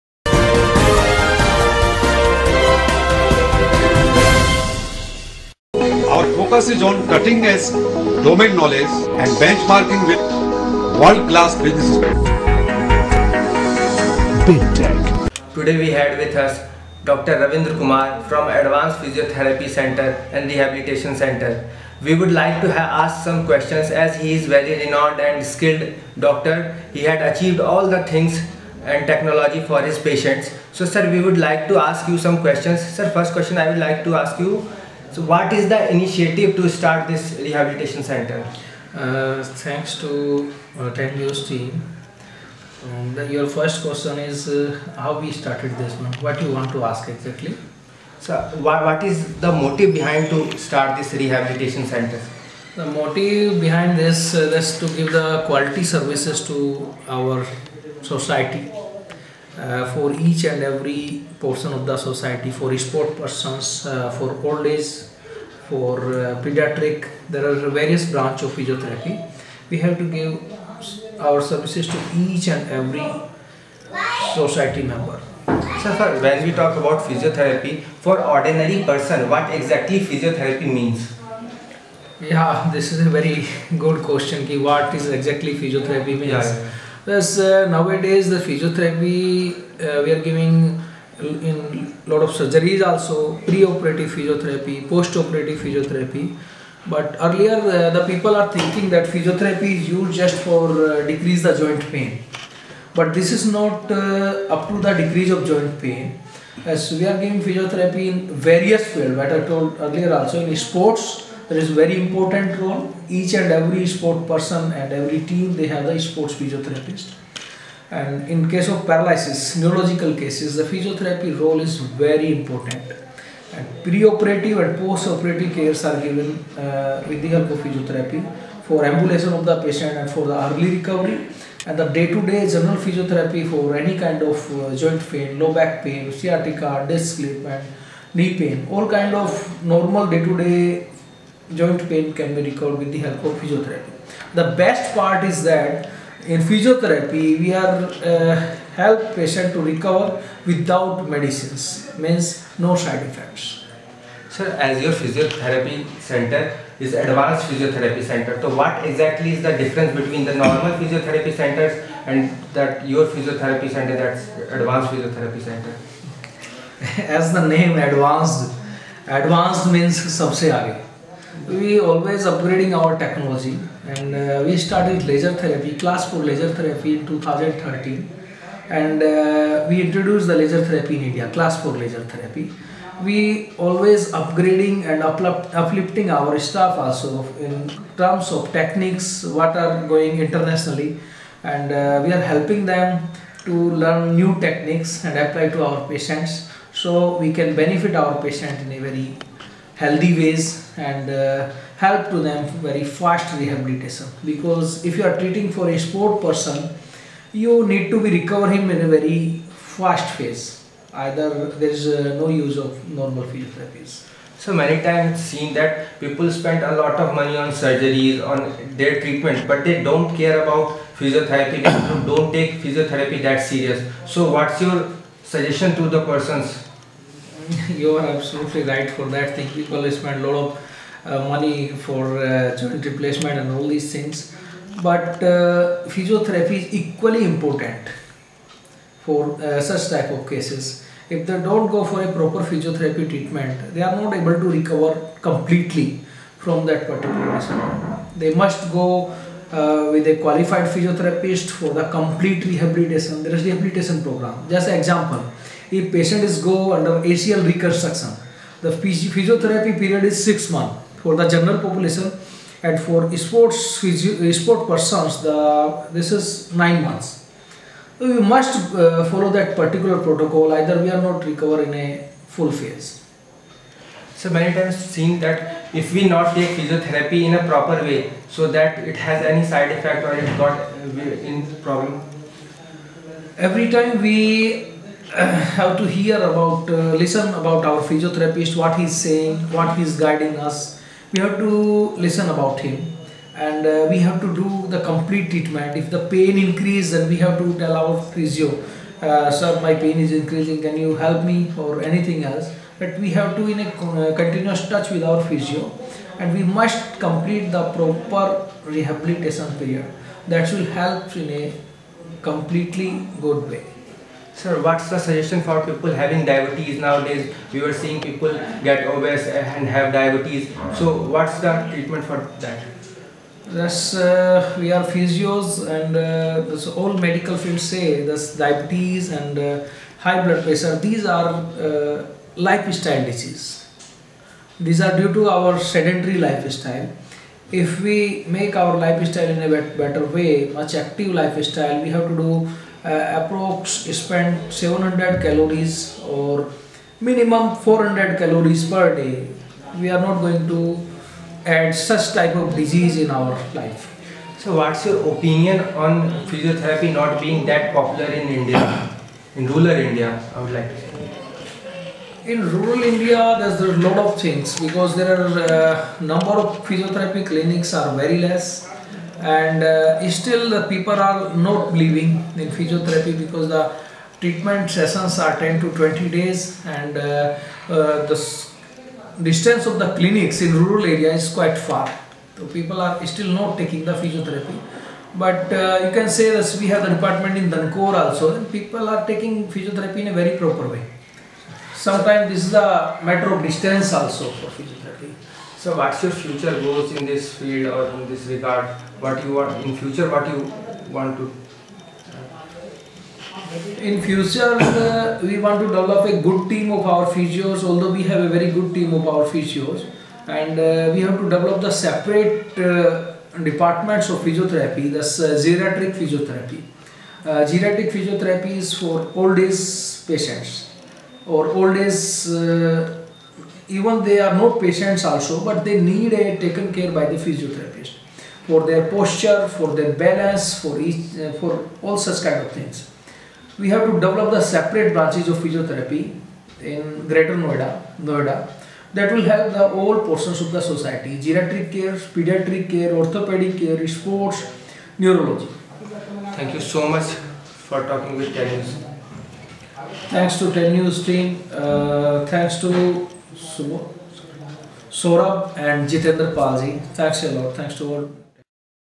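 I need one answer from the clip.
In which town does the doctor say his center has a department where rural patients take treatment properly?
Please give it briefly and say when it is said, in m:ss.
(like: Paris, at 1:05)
Dankaur, at 6:27.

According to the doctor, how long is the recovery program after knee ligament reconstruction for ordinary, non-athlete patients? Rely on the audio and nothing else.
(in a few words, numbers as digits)
six months.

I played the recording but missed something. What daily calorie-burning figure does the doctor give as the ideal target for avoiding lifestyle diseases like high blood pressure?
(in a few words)
700 calories.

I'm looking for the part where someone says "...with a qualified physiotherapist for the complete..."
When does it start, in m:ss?
4:09.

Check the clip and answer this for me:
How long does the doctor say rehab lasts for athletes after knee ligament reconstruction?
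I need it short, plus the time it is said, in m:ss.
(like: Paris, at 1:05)
nine months, at 4:26.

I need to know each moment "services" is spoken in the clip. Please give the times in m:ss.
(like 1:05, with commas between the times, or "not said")
0:55, 1:11.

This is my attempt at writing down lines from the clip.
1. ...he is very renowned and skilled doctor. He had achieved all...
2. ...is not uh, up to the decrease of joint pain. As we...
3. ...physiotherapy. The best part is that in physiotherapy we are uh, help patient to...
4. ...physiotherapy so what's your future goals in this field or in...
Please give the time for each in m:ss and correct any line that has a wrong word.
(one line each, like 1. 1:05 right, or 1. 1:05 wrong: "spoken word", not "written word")
1. 0:24 right
2. 1:43 right
3. 2:23 right
4. 6:34 right.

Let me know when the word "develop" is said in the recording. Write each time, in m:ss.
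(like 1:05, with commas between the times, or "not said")
6:45, 6:51, 7:13.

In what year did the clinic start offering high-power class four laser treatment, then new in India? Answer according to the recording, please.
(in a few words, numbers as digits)
2013.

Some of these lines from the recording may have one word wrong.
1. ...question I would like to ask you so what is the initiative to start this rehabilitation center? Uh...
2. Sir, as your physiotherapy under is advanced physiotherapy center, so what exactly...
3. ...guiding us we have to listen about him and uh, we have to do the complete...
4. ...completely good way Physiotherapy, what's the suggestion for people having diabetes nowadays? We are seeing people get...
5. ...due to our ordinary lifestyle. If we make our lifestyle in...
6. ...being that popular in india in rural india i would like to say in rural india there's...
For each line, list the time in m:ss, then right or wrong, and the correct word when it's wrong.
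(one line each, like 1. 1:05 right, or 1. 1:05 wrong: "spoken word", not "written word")
1. 0:33 right
2. 2:34 wrong: "center", not "under"
3. 4:49 right
4. 5:12 wrong: "Sir", not "Physiotherapy"
5. 5:34 wrong: "sedentary", not "ordinary"
6. 5:57 right.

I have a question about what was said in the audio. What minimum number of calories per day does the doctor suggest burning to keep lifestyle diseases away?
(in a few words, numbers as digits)
400 calories.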